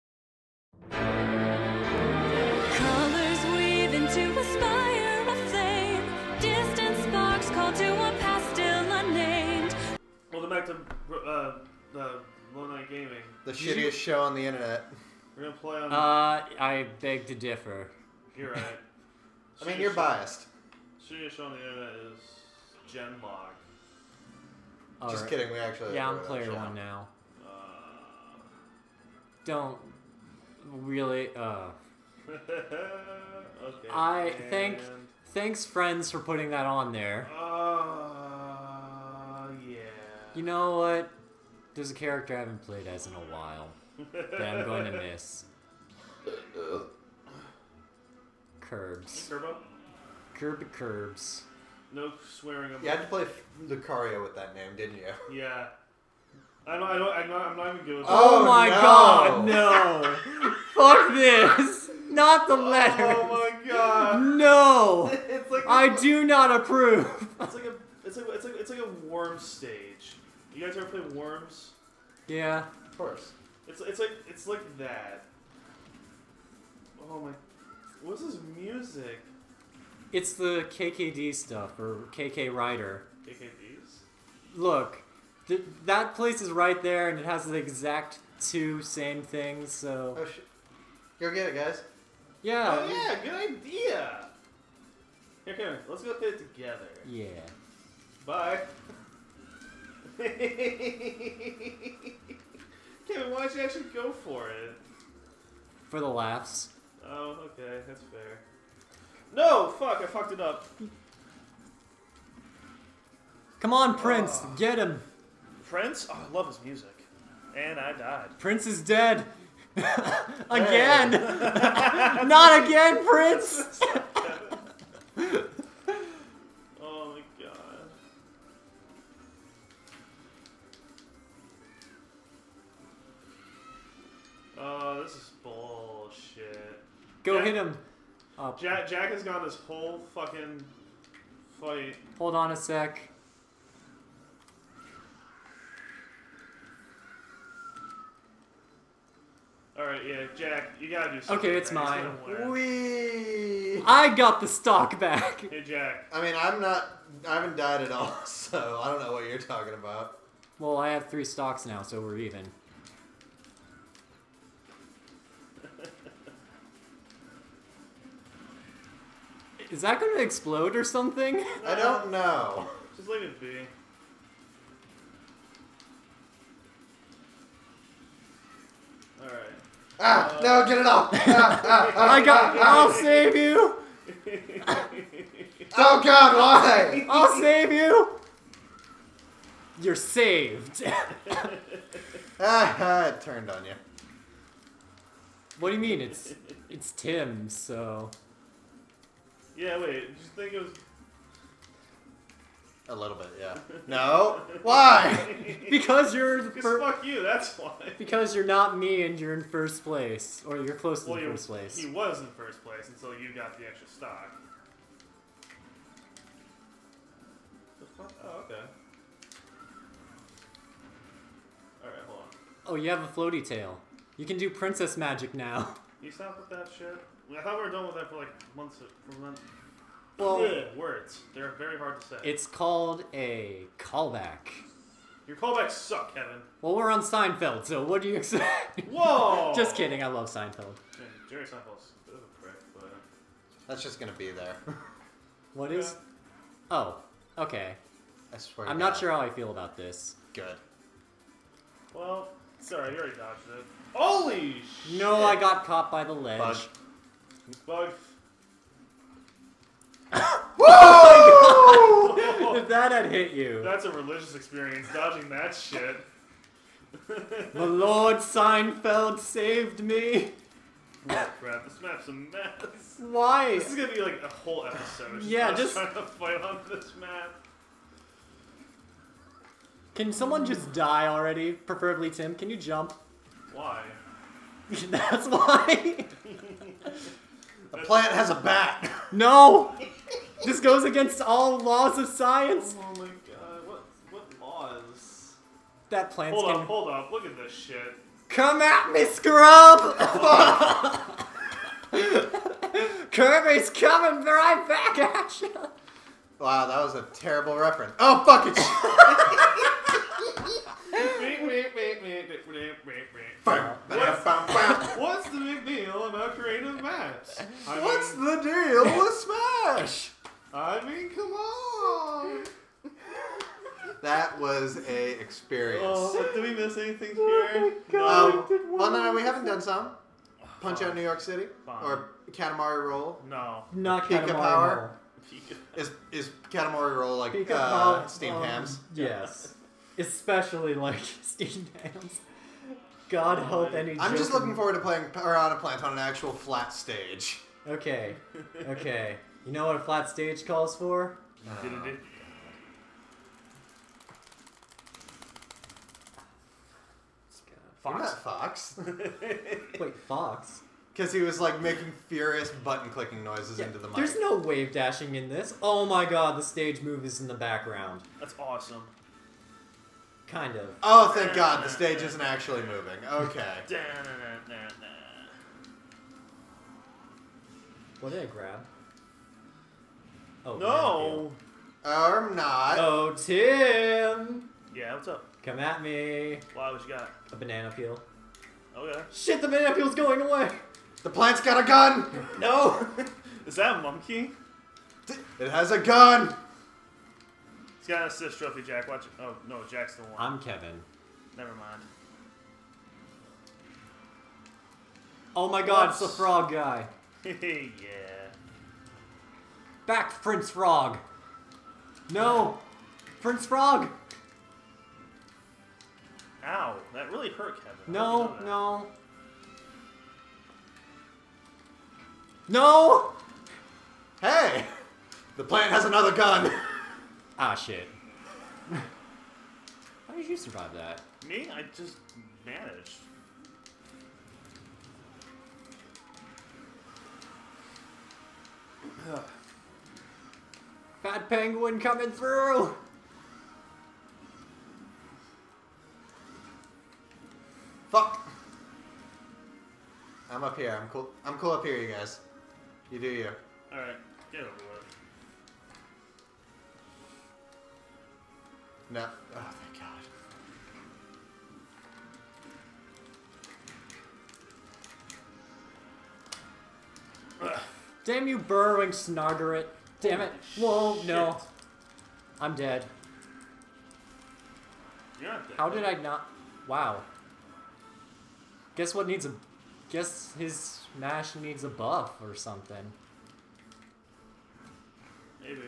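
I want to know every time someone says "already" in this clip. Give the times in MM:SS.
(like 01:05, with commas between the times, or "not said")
04:12, 04:41.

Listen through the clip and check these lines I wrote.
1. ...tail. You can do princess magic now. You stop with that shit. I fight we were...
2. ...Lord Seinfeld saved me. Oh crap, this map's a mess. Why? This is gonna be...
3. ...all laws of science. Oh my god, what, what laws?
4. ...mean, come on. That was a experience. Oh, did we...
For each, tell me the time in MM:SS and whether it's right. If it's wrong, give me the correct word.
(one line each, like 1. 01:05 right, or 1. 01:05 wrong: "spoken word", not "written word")
1. 03:43 wrong: "thought", not "fight"
2. 04:27 right
3. 04:51 right
4. 05:20 right.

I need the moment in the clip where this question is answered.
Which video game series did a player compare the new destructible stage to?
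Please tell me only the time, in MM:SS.
01:11.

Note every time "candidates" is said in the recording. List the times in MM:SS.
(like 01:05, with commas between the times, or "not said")
not said.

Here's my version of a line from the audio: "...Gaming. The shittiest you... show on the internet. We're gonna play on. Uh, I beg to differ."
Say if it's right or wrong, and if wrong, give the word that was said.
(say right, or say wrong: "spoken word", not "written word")
right.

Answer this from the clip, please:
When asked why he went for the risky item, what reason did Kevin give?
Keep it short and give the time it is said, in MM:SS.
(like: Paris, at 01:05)
For the laughs, at 01:45.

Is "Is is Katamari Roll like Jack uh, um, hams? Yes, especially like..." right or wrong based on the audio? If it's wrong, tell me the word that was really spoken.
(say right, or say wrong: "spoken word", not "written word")
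wrong: "Pika", not "Jack".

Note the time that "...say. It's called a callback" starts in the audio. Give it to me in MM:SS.
03:52.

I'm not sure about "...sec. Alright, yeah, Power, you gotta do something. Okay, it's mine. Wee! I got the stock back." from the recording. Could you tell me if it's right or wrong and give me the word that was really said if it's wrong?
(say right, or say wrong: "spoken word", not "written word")
wrong: "Jack", not "Power".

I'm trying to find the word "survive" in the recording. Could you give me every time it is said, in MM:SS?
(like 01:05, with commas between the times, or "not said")
07:10.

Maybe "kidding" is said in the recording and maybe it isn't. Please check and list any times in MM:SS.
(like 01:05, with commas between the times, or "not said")
00:25, 03:59.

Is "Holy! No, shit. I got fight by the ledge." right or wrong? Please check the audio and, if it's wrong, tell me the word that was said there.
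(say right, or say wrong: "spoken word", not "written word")
wrong: "caught", not "fight".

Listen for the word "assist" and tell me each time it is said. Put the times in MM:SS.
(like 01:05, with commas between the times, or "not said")
06:38.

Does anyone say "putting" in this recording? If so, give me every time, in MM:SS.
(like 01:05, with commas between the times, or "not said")
00:36.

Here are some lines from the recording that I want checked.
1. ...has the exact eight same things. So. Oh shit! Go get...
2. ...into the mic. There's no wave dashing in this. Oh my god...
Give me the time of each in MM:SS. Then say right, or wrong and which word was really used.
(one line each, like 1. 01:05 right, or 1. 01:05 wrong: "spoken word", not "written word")
1. 01:27 wrong: "two", not "eight"
2. 06:03 right.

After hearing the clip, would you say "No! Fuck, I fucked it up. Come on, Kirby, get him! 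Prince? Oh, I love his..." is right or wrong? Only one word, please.
wrong.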